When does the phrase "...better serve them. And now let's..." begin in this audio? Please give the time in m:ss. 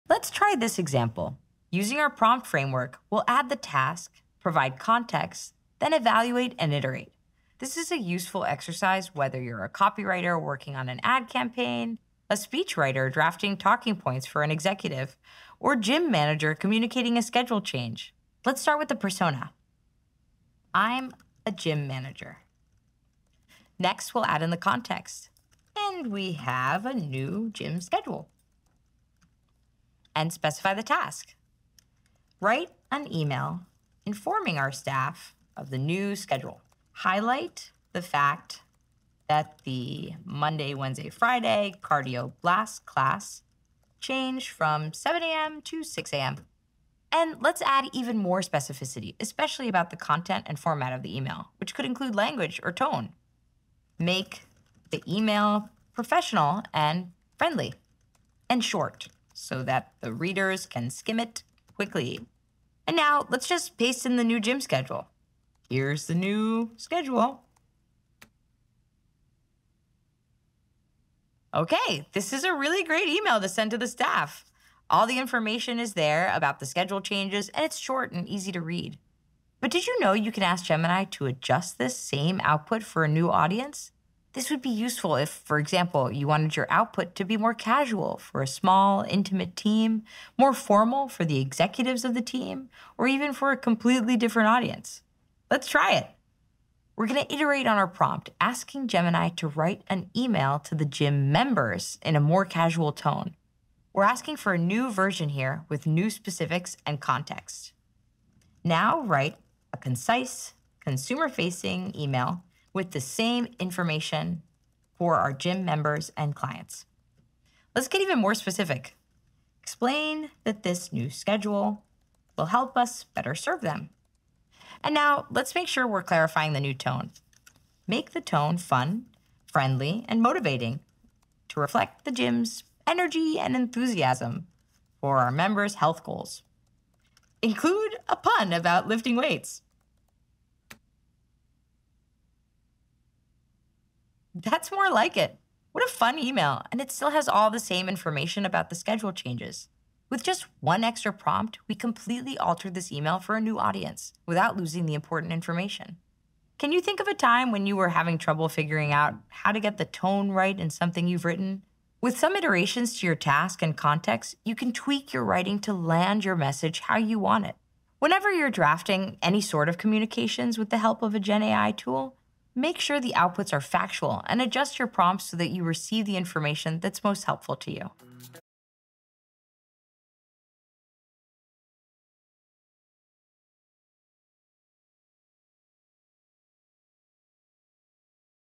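2:03.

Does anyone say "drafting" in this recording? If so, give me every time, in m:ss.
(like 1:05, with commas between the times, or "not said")
0:13, 2:48.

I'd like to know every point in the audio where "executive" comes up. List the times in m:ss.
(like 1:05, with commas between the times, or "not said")
0:14, 1:31.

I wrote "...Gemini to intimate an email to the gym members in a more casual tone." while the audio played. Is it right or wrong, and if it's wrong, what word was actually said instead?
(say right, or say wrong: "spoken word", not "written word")
wrong: "write", not "intimate".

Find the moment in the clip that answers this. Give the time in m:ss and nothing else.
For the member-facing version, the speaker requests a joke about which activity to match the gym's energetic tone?
2:18.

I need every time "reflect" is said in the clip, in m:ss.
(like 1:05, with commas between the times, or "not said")
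2:11.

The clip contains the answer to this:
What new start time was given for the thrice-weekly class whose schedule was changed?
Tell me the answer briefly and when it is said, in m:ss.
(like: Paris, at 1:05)
6 a.m., at 0:45.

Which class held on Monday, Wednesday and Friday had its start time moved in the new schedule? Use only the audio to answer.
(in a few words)
Cardio blast.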